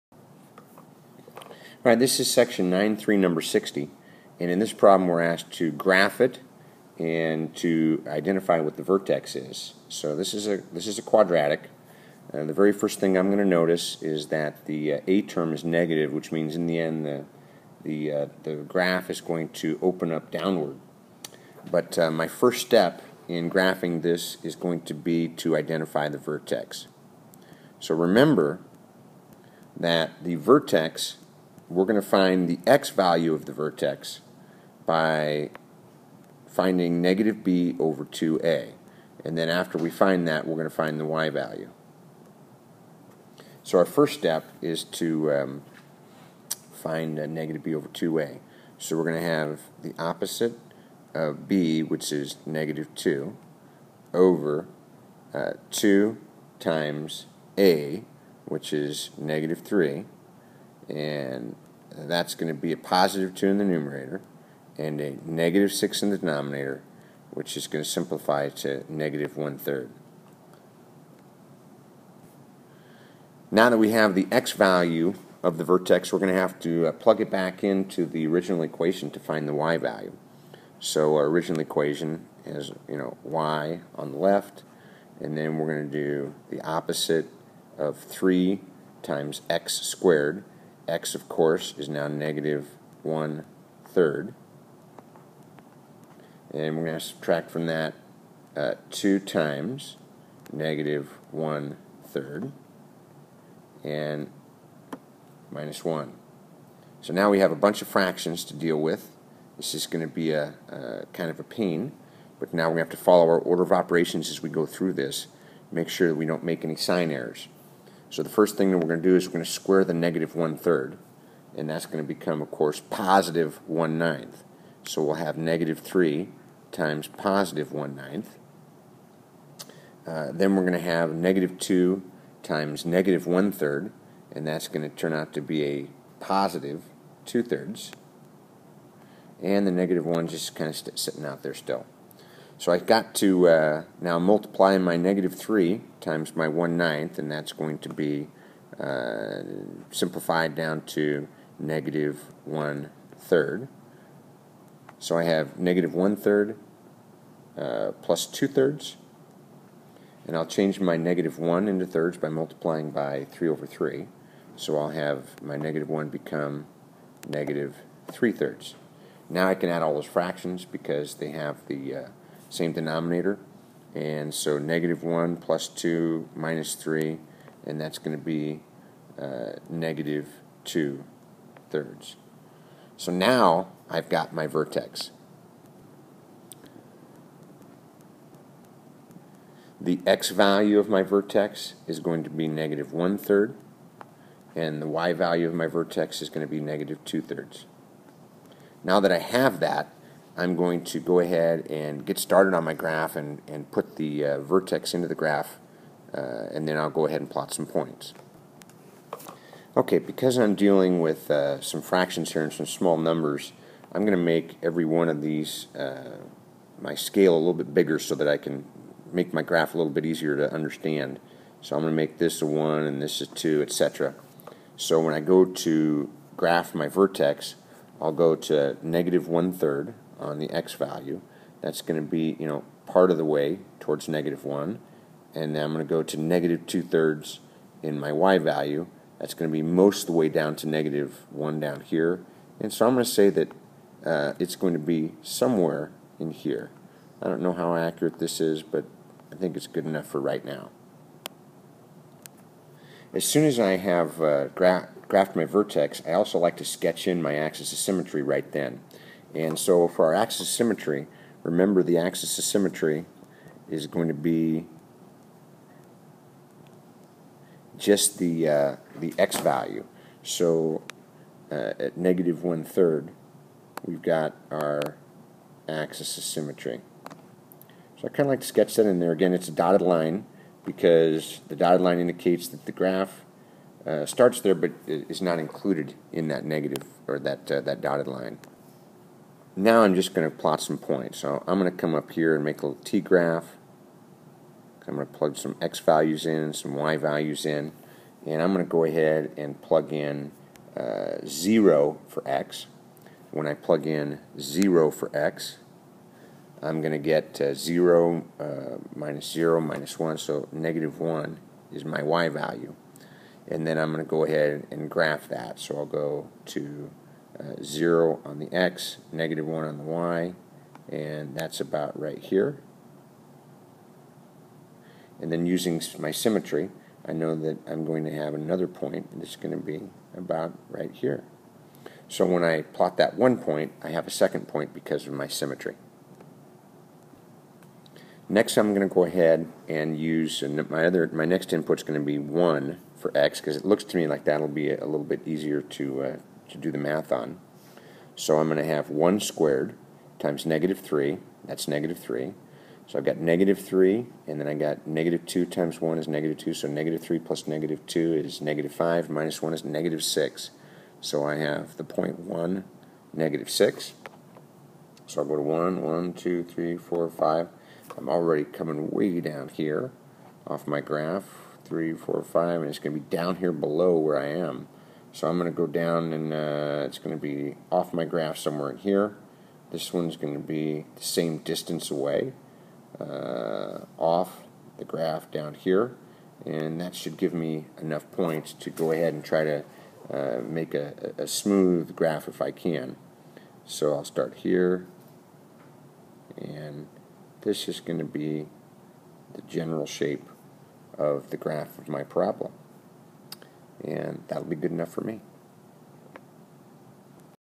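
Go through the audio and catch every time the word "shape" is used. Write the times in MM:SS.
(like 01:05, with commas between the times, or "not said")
06:39.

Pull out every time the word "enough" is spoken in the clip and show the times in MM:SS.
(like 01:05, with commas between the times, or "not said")
04:09, 06:27, 06:44.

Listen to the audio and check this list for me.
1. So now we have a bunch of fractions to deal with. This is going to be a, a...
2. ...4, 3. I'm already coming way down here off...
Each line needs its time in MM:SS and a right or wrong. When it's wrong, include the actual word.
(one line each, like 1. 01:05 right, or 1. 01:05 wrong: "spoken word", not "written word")
1. 01:47 right
2. 06:06 wrong: "5", not "3".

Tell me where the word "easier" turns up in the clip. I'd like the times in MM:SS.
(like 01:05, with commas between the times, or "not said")
03:40, 05:45.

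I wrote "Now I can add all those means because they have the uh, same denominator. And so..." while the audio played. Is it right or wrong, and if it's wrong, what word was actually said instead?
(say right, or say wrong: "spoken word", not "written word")
wrong: "fractions", not "means".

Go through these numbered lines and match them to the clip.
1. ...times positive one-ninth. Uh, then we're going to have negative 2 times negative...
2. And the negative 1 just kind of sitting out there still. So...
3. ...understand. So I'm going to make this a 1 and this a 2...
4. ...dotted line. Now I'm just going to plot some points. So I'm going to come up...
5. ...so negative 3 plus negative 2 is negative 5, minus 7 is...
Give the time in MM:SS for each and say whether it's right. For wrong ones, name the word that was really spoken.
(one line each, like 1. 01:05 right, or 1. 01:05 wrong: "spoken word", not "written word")
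1. 02:06 right
2. 02:19 right
3. 03:40 right
4. 04:47 right
5. 05:56 wrong: "1", not "7".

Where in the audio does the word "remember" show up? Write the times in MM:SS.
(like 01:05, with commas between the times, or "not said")
00:27, 04:21.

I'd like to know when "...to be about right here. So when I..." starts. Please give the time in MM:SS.
05:29.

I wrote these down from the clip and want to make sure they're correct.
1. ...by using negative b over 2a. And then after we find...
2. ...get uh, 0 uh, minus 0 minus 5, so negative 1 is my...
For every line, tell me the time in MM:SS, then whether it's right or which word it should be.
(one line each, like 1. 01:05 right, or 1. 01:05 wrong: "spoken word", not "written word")
1. 00:34 wrong: "finding", not "using"
2. 05:06 wrong: "1", not "5".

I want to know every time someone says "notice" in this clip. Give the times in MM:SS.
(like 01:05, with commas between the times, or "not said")
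00:13.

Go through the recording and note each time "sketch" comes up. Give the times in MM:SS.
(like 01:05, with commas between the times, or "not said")
04:16, 04:38.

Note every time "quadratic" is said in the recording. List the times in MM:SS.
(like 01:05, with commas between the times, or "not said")
00:11.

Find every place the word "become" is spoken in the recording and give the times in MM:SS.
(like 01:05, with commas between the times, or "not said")
02:02, 02:46.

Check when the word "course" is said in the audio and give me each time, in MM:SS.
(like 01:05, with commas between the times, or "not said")
01:31, 02:02.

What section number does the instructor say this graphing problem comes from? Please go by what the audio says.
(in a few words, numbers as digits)
93.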